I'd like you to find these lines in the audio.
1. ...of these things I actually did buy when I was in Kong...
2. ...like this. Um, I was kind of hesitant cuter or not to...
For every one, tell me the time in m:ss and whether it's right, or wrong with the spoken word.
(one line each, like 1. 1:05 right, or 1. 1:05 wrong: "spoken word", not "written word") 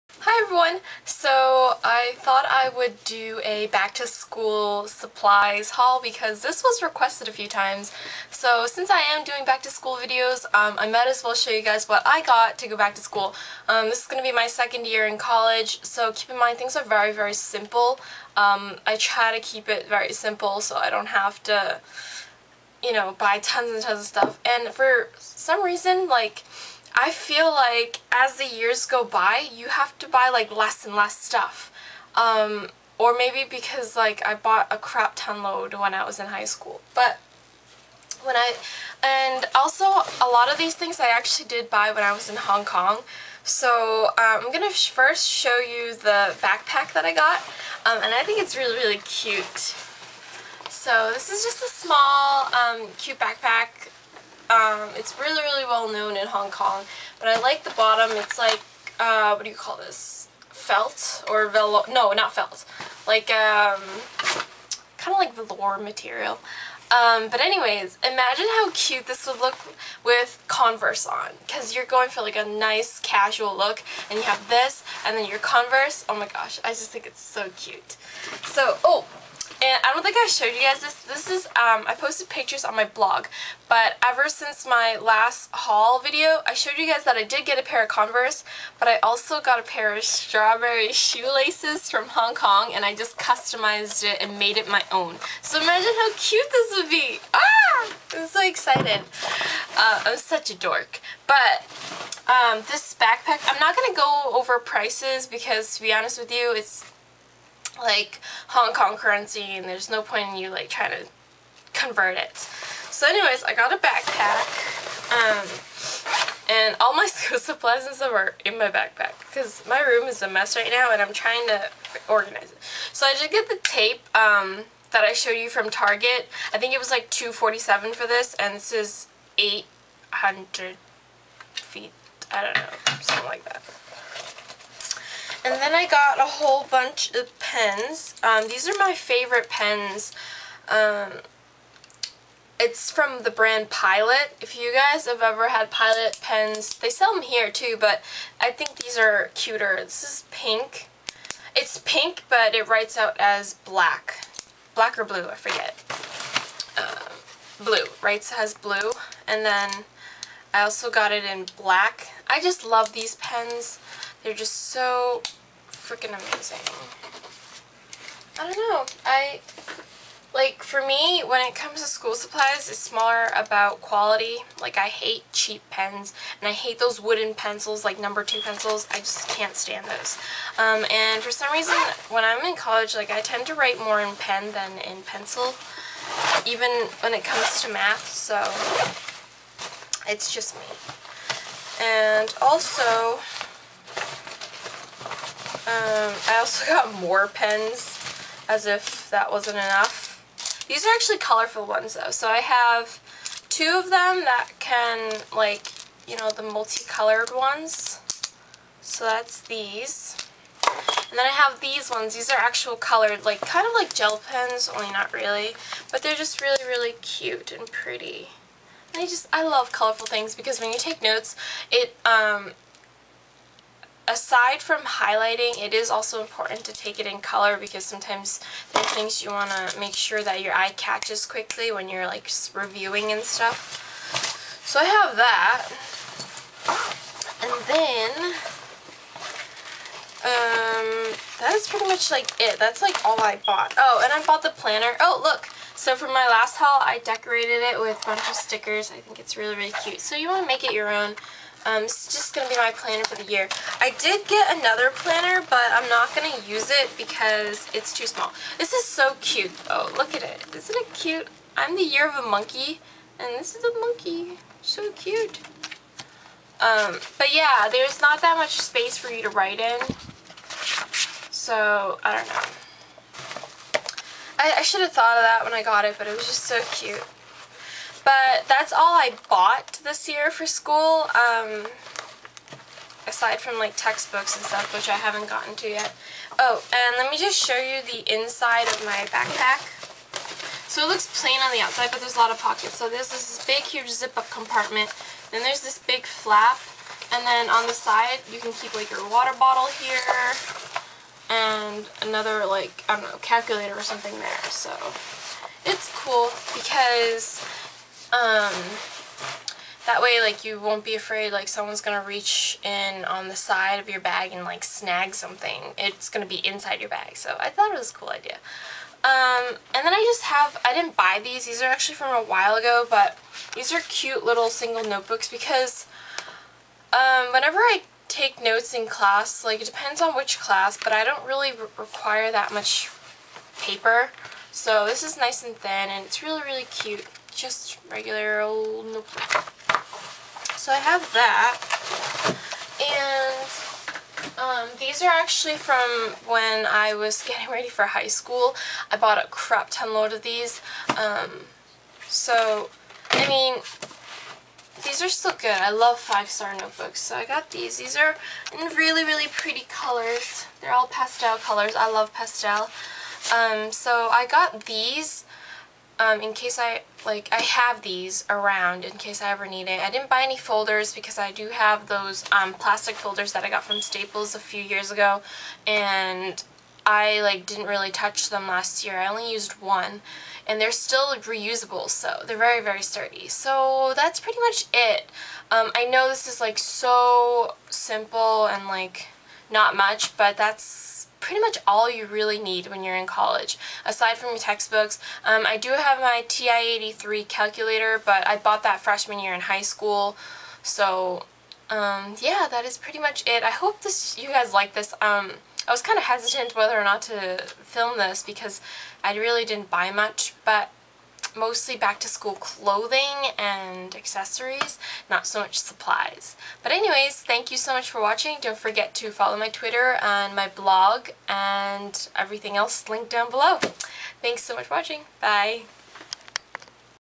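1. 0:40 wrong: "Hong", not "Kong"
2. 6:44 wrong: "whether", not "cuter".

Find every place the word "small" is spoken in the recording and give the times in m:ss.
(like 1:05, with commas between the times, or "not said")
0:51, 4:18.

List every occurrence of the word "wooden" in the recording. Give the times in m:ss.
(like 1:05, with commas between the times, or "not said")
2:56.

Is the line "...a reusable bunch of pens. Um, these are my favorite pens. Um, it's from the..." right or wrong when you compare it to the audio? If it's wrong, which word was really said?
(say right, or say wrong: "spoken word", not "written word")
wrong: "whole", not "reusable".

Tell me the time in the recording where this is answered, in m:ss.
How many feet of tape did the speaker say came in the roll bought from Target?
2:09.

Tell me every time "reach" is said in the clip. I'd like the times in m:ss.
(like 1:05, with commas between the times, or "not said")
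5:12.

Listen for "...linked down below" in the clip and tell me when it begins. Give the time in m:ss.
7:02.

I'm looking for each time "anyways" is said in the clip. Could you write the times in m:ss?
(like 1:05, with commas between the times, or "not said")
1:07, 1:53, 6:56.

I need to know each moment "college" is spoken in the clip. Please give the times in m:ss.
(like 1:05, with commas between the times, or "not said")
0:15, 3:02, 6:33.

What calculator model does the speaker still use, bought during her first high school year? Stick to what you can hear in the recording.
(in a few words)
TI-83.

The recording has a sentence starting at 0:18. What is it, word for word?
Um, I try to keep it very simple so I don't have to, you know, buy tons and tons of stuff.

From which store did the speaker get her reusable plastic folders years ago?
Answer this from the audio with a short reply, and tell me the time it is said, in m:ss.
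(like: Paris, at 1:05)
Staples, at 6:13.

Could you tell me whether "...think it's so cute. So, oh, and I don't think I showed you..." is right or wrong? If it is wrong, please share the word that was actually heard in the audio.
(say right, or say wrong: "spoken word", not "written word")
right.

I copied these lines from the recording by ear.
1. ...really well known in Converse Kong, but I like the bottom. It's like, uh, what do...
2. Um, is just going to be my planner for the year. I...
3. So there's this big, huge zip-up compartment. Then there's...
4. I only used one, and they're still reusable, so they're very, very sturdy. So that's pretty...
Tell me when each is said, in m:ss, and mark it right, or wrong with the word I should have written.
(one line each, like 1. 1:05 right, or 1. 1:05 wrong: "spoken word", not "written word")
1. 0:55 wrong: "Hong", not "Converse"
2. 4:11 right
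3. 4:52 right
4. 6:18 right.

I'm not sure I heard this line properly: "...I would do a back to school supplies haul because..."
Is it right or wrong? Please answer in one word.
right.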